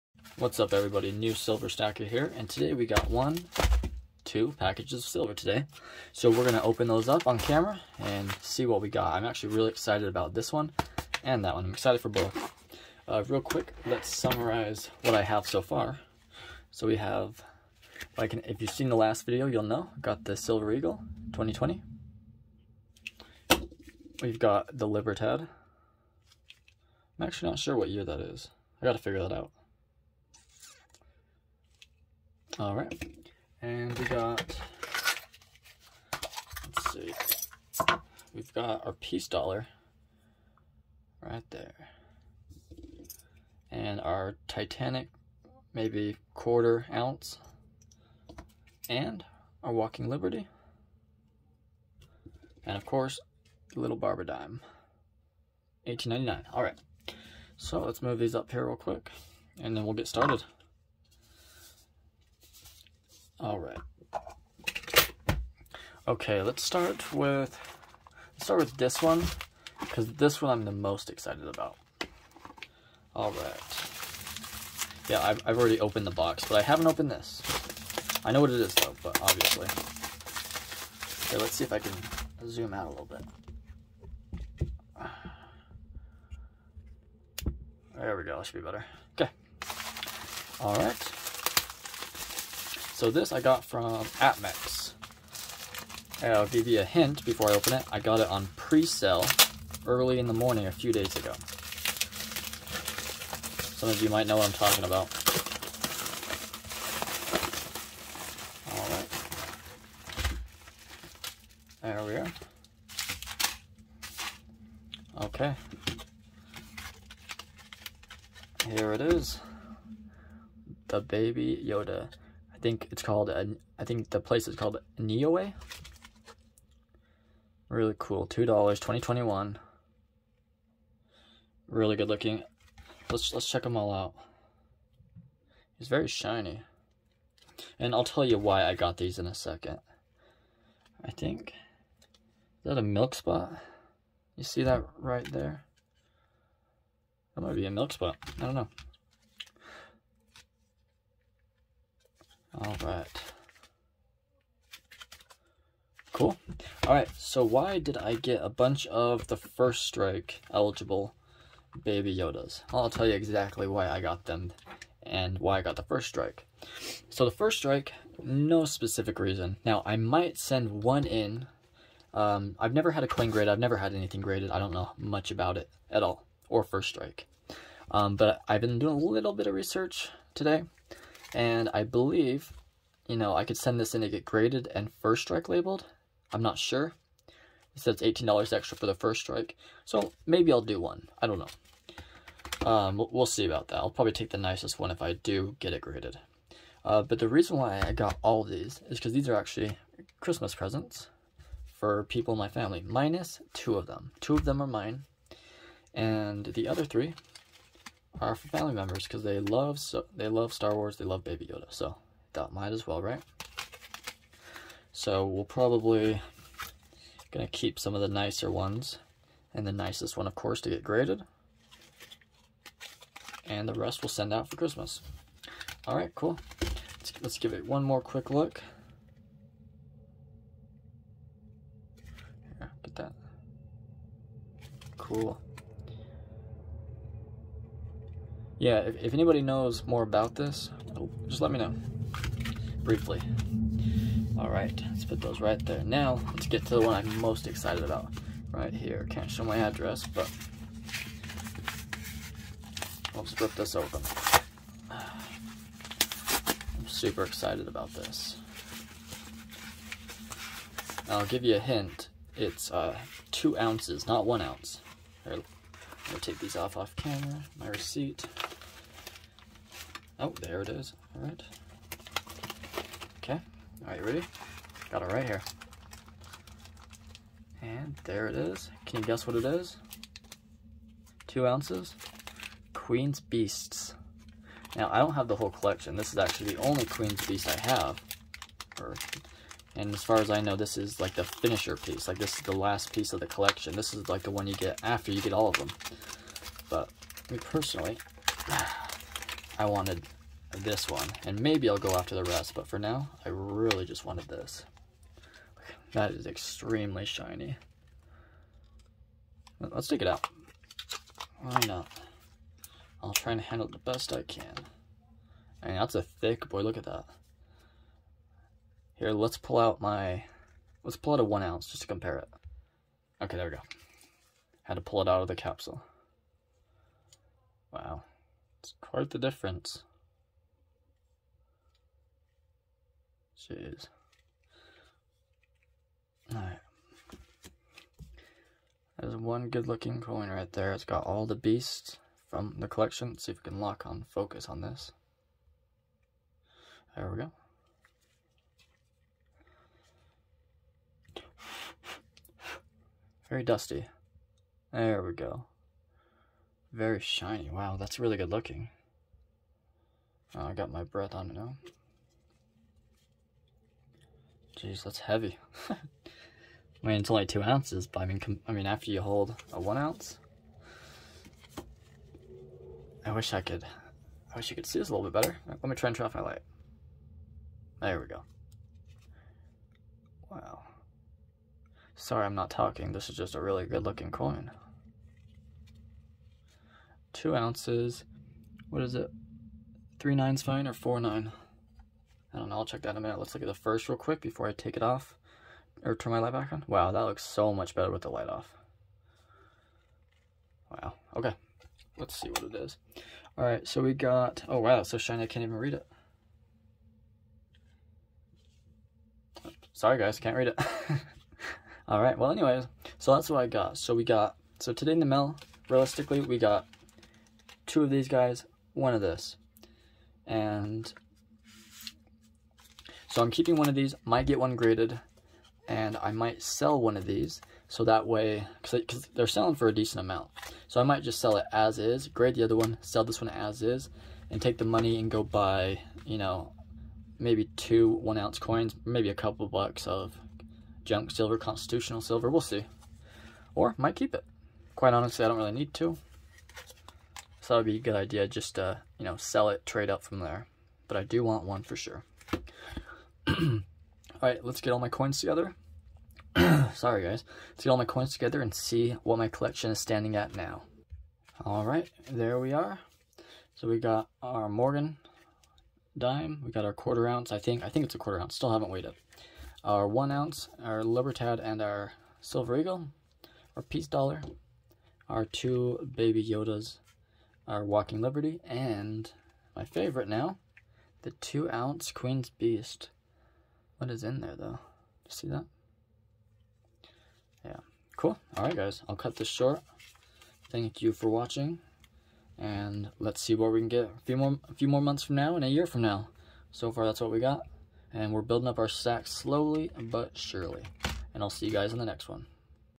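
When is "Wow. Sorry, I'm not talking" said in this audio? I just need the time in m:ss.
6:20.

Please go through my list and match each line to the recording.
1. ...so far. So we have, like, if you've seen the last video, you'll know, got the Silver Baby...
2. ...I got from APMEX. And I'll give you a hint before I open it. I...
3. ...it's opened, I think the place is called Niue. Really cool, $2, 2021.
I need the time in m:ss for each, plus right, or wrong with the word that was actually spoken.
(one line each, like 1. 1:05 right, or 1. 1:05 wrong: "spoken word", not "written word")
1. 0:15 wrong: "Eagle", not "Baby"
2. 1:33 right
3. 2:02 wrong: "called", not "opened".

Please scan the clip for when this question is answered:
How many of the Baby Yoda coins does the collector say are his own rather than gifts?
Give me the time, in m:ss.
3:24.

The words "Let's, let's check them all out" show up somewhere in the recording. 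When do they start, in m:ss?
2:13.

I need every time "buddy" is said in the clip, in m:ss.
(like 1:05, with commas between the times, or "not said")
not said.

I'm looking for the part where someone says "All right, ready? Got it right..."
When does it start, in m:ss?
4:33.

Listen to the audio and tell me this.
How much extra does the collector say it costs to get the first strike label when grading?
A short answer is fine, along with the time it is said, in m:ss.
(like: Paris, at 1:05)
$18, at 3:07.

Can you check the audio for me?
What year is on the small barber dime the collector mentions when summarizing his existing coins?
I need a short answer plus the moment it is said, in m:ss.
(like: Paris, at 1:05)
1899, at 0:55.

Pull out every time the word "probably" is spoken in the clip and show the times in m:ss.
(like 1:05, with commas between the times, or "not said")
3:13, 3:35.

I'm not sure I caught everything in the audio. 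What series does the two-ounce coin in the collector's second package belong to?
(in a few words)
Queen's Beasts.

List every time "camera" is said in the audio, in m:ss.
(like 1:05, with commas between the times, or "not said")
0:07, 4:26.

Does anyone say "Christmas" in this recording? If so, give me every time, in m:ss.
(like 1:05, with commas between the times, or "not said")
3:20, 3:44.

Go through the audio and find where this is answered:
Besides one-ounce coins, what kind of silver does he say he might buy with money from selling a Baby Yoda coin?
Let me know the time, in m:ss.
7:20.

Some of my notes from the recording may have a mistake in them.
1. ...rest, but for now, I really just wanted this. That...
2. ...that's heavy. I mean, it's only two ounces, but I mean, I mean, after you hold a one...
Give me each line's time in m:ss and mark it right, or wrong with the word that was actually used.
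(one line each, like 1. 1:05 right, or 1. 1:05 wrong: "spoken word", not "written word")
1. 5:02 right
2. 6:04 right.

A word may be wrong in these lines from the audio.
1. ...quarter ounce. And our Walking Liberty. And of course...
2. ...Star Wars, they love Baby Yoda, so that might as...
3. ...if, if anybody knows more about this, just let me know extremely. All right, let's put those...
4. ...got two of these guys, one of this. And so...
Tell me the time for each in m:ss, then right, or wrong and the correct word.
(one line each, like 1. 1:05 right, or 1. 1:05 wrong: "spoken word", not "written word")
1. 0:46 right
2. 3:30 right
3. 3:58 wrong: "briefly", not "extremely"
4. 6:56 right.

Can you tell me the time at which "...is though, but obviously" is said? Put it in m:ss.
1:18.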